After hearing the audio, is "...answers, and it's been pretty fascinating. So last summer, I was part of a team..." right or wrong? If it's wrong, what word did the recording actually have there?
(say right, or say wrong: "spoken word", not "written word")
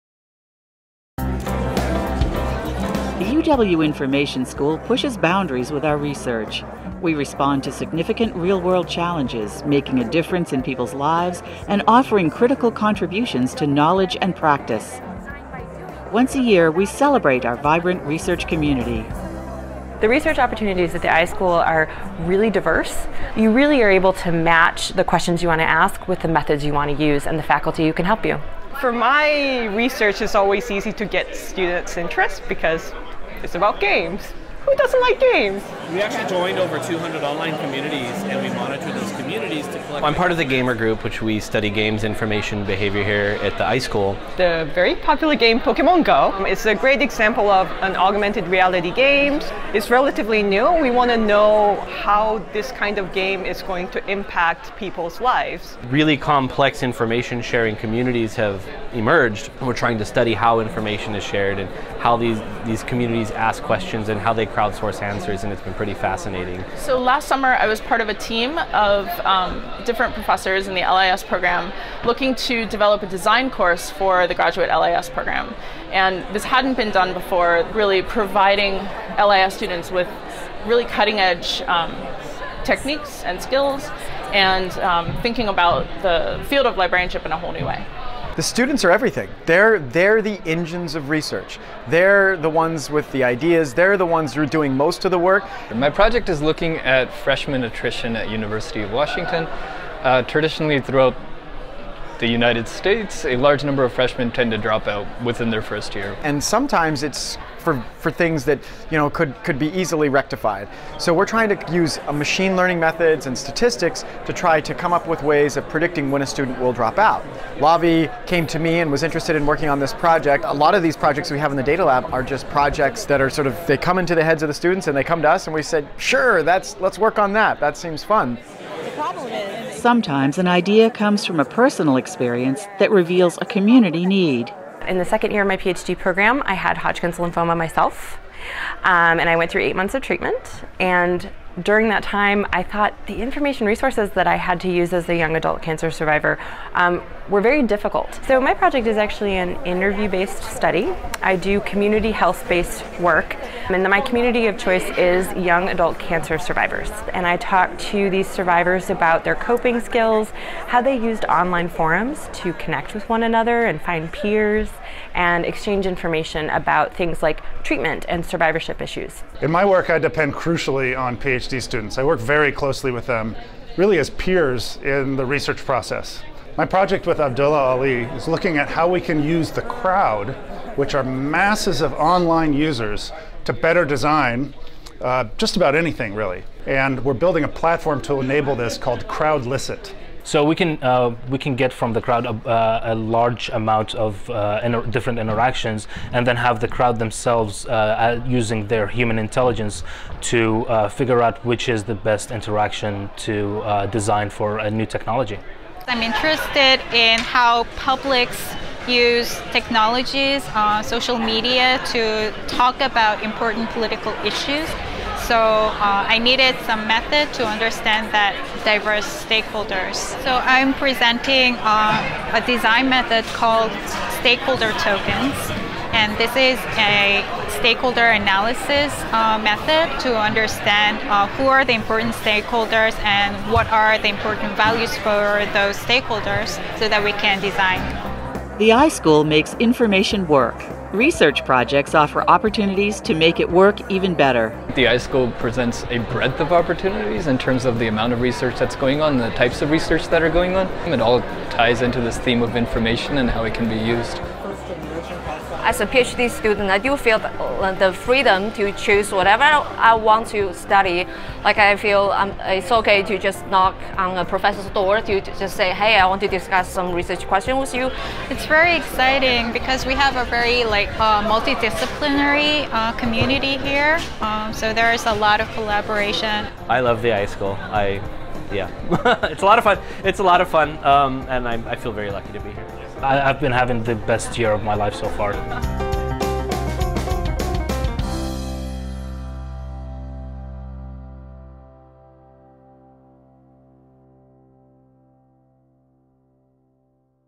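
right.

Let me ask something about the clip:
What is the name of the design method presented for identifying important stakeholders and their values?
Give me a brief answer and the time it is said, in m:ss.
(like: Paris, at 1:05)
stakeholder tokens, at 3:44.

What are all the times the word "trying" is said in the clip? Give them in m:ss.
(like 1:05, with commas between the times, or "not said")
0:59, 1:51.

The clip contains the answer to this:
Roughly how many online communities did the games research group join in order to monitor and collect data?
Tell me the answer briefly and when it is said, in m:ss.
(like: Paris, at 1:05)
over 200, at 0:36.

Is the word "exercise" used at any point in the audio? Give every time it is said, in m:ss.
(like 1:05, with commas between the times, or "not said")
not said.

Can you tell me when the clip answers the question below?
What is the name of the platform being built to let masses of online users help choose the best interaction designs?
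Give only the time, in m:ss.
3:09.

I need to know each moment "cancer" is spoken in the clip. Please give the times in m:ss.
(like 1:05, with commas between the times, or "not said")
2:25, 2:35.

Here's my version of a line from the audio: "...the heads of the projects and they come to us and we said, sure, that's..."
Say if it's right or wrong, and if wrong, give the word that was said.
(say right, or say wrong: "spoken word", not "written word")
wrong: "students", not "projects".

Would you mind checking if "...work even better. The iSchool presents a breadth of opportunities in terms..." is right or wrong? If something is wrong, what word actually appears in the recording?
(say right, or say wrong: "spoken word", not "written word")
right.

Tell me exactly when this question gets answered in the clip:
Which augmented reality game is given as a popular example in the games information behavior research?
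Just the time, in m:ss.
0:45.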